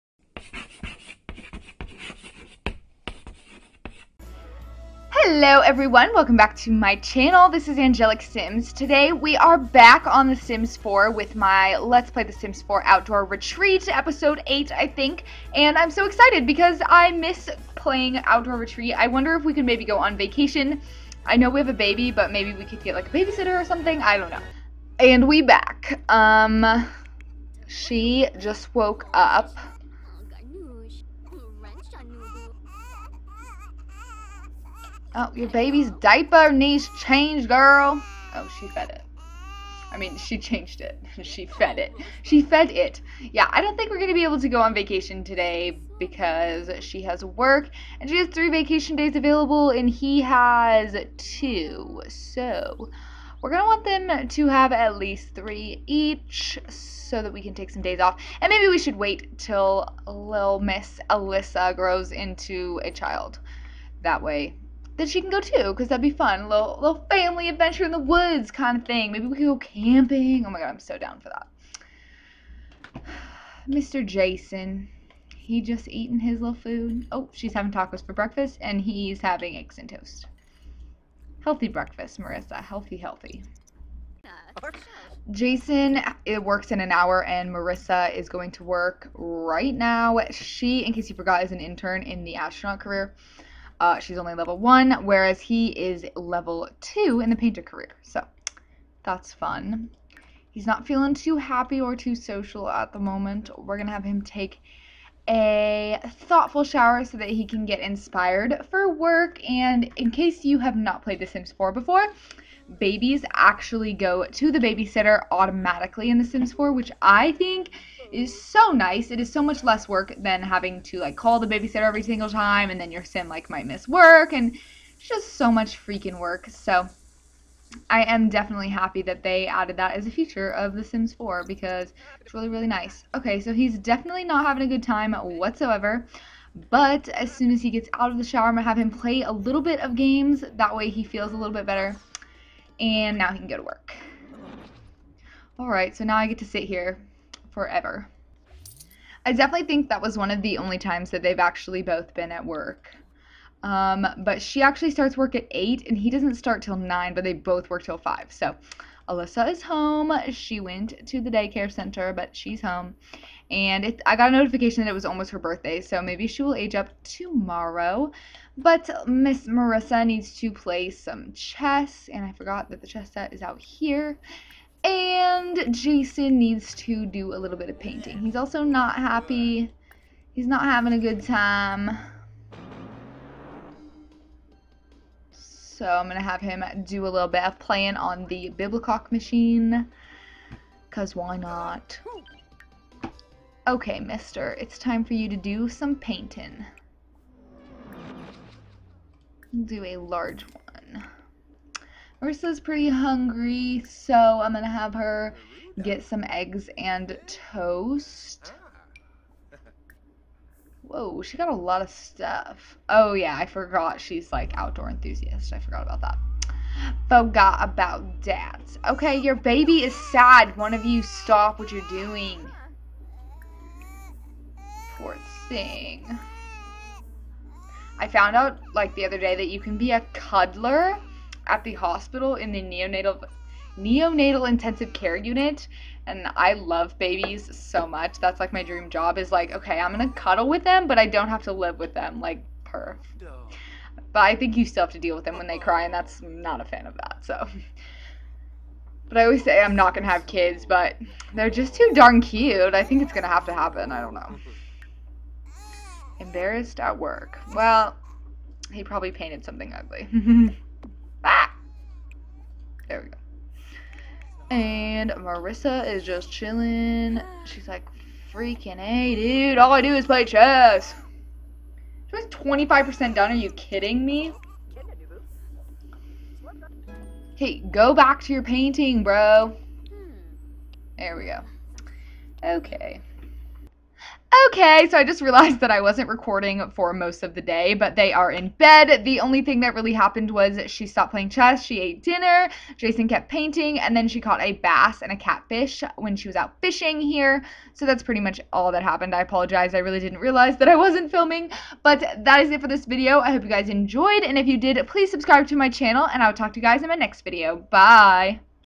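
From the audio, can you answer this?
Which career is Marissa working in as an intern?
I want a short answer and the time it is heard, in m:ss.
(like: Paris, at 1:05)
Astronaut, at 1:32.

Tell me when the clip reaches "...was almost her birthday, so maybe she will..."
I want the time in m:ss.
2:44.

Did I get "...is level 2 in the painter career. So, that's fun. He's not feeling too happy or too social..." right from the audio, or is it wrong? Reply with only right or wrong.
right.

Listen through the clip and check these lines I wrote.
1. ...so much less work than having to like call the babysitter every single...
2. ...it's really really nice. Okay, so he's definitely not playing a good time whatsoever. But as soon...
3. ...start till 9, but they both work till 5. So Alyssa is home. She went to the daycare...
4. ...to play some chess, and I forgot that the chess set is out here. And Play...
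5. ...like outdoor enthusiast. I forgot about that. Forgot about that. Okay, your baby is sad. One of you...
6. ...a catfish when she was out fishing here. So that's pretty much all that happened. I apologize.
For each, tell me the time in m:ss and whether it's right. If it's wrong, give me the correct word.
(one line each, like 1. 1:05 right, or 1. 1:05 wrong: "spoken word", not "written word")
1. 1:59 right
2. 2:12 wrong: "having", not "playing"
3. 2:36 right
4. 2:50 wrong: "Jason", not "Play"
5. 3:34 right
6. 4:55 right.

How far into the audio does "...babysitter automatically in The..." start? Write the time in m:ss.
1:54.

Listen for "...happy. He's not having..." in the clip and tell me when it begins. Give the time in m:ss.
2:58.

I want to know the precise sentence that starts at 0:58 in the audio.
And maybe we should wait till little Miss Alyssa grows into a child.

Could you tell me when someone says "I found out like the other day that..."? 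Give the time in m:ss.
3:47.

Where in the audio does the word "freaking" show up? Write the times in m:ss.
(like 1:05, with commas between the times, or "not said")
2:05, 4:28.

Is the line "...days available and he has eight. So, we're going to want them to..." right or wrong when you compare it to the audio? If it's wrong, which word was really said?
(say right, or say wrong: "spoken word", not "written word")
wrong: "two", not "eight".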